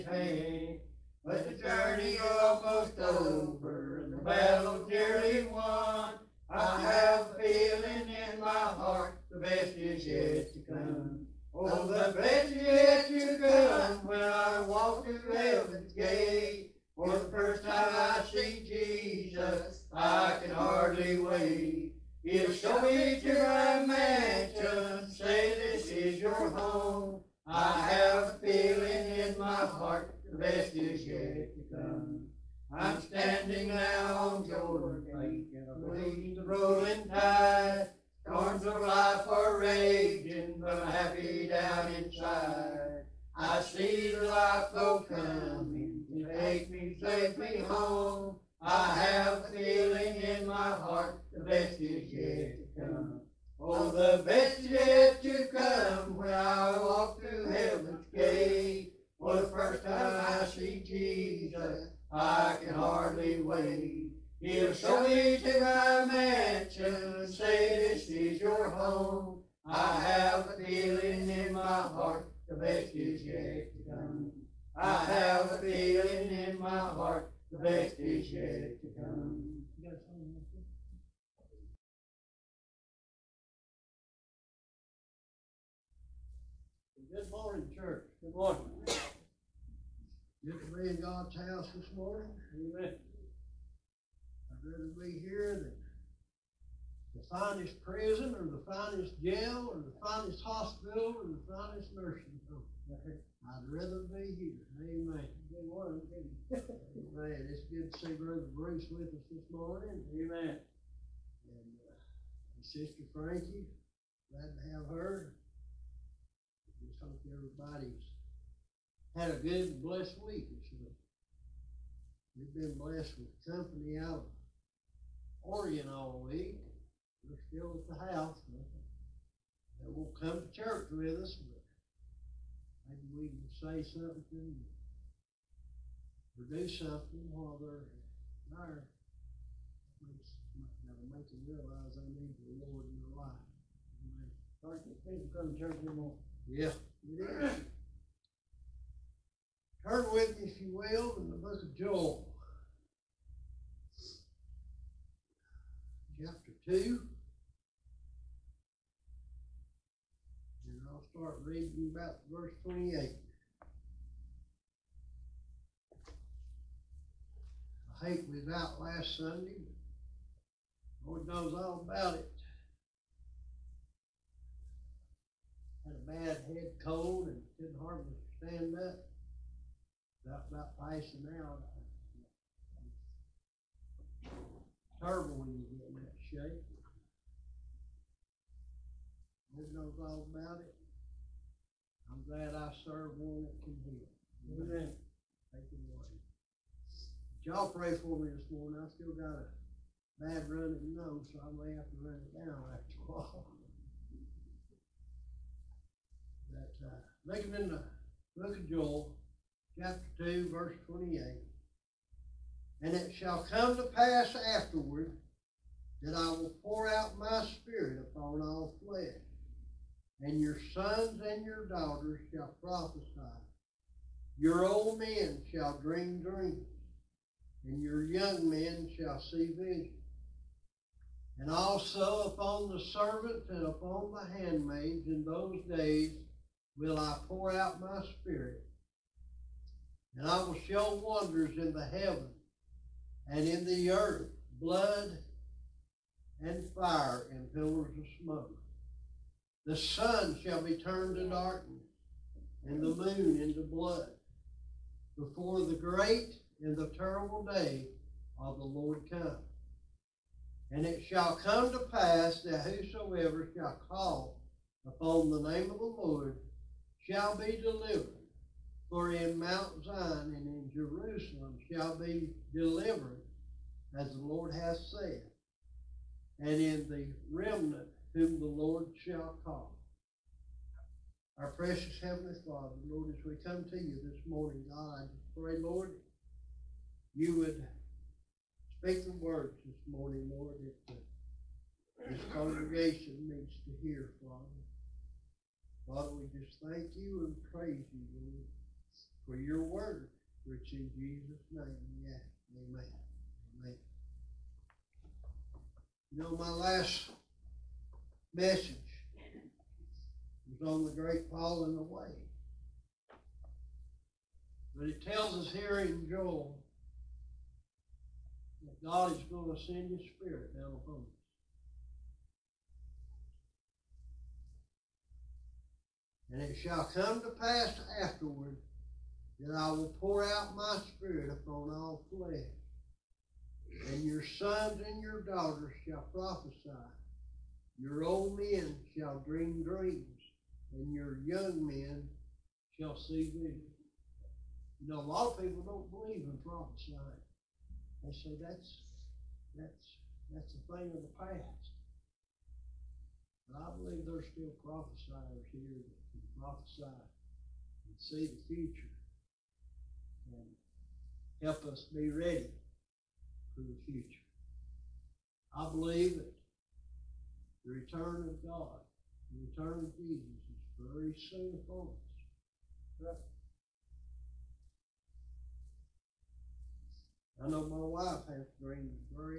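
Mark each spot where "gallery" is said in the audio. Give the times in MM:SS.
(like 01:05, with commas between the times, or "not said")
not said.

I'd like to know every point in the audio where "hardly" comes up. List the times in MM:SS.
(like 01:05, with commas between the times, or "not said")
00:20, 01:02, 02:57.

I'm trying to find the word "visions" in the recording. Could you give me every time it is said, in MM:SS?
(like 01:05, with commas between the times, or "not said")
03:49, 05:43.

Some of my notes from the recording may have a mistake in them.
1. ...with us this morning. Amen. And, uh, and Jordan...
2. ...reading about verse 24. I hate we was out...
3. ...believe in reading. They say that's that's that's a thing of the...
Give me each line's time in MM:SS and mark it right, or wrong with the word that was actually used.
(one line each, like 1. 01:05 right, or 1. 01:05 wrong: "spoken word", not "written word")
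1. 01:48 wrong: "Sister", not "Jordan"
2. 02:41 wrong: "28", not "24"
3. 05:45 wrong: "prophesying", not "reading".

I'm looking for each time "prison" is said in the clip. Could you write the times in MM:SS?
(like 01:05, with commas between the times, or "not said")
01:37.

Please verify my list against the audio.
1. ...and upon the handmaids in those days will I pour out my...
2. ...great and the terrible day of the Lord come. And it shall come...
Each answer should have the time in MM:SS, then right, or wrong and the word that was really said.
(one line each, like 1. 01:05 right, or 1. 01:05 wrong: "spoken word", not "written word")
1. 03:53 right
2. 04:15 right.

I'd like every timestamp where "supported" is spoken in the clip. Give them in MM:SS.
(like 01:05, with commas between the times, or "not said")
not said.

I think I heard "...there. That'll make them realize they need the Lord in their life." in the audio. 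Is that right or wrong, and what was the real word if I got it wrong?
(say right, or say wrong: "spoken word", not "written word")
right.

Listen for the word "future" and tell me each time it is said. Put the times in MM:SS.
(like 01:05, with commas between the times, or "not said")
05:58, 06:03.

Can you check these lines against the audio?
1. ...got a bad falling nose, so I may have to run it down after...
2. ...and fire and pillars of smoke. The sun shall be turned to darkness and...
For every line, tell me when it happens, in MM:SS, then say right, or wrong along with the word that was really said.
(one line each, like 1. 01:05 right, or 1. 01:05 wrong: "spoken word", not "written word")
1. 03:19 wrong: "running", not "falling"
2. 04:06 right.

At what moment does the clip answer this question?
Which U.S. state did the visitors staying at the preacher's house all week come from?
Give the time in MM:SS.
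02:05.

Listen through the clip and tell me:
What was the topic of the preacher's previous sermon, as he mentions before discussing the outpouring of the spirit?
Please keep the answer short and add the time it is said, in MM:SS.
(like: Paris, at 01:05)
The great falling away, at 05:10.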